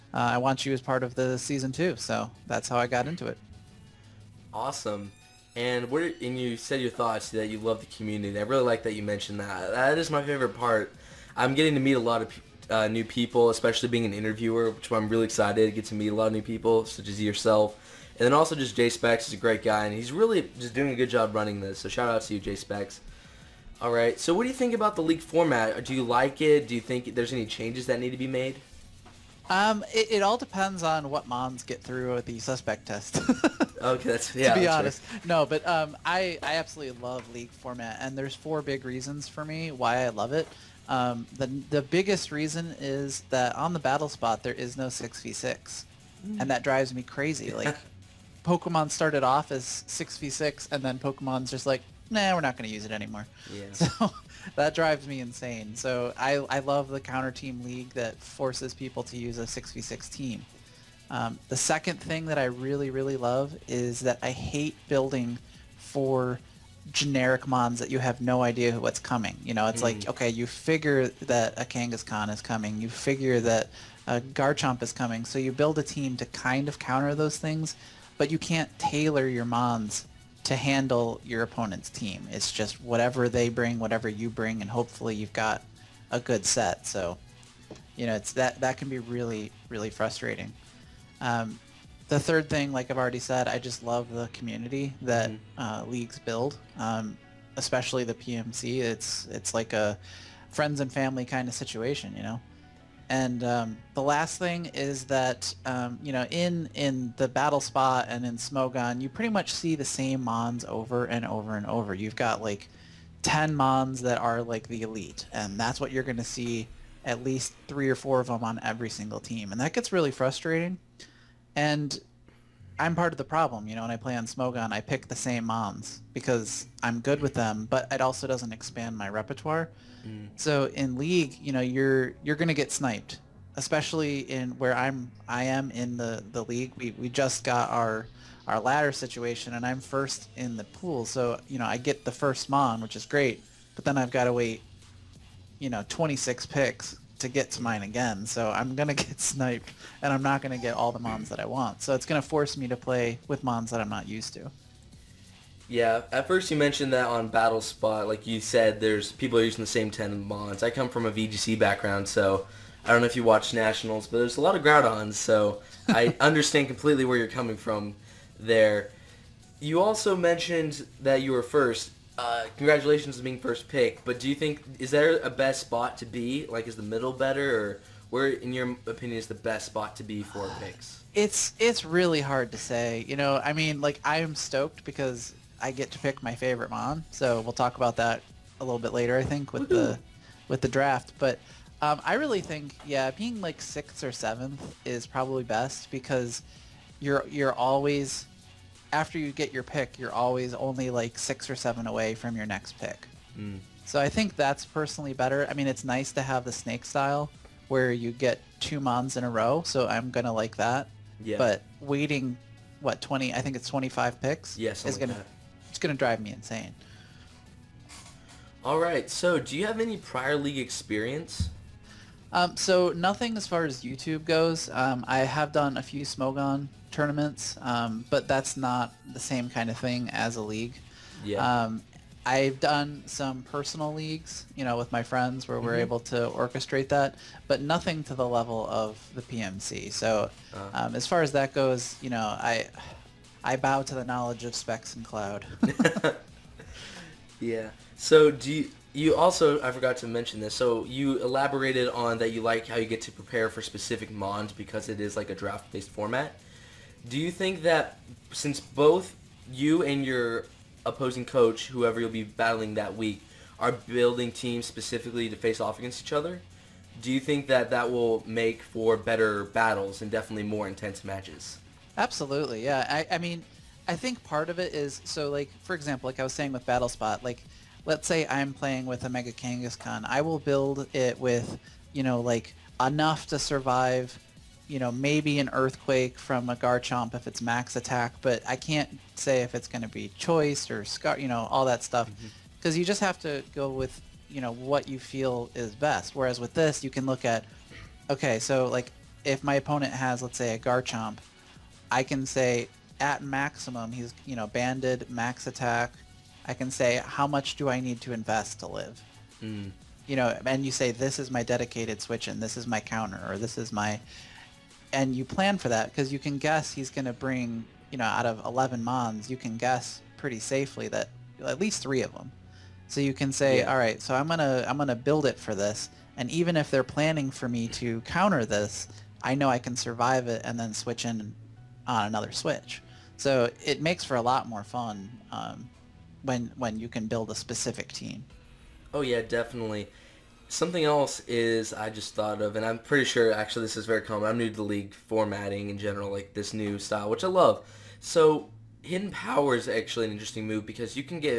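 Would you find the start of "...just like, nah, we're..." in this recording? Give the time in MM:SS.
00:51.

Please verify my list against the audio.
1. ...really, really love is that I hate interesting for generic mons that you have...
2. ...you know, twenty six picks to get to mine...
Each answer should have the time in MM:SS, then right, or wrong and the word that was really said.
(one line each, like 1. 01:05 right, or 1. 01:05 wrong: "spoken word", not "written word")
1. 01:02 wrong: "building", not "interesting"
2. 02:25 right.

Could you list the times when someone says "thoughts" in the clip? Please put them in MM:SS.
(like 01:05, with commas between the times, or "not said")
00:06, 05:42.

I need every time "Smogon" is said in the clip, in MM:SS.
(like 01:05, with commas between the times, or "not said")
01:48, 02:04, 03:46.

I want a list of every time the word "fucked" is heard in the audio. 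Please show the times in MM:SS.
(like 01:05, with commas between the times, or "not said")
not said.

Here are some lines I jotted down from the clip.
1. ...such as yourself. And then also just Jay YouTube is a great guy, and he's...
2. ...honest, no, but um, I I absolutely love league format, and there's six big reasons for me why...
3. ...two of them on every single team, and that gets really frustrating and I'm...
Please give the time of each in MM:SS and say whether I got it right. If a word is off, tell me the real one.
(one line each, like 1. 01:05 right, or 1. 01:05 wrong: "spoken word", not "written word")
1. 00:16 wrong: "Specs", not "YouTube"
2. 00:34 wrong: "four", not "six"
3. 01:57 wrong: "four", not "two".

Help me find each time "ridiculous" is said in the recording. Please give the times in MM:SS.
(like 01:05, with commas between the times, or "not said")
not said.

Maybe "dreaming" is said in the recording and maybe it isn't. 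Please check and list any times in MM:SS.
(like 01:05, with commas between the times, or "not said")
not said.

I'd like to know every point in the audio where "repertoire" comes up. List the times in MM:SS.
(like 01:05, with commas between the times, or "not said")
02:09.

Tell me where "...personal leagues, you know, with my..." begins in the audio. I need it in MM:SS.
03:53.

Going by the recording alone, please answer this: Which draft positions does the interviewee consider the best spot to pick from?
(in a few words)
6th or 7th.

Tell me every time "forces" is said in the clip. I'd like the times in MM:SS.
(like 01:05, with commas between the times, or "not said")
00:58, 02:32.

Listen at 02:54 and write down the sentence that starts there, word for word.
But do you think is there a best spot to be?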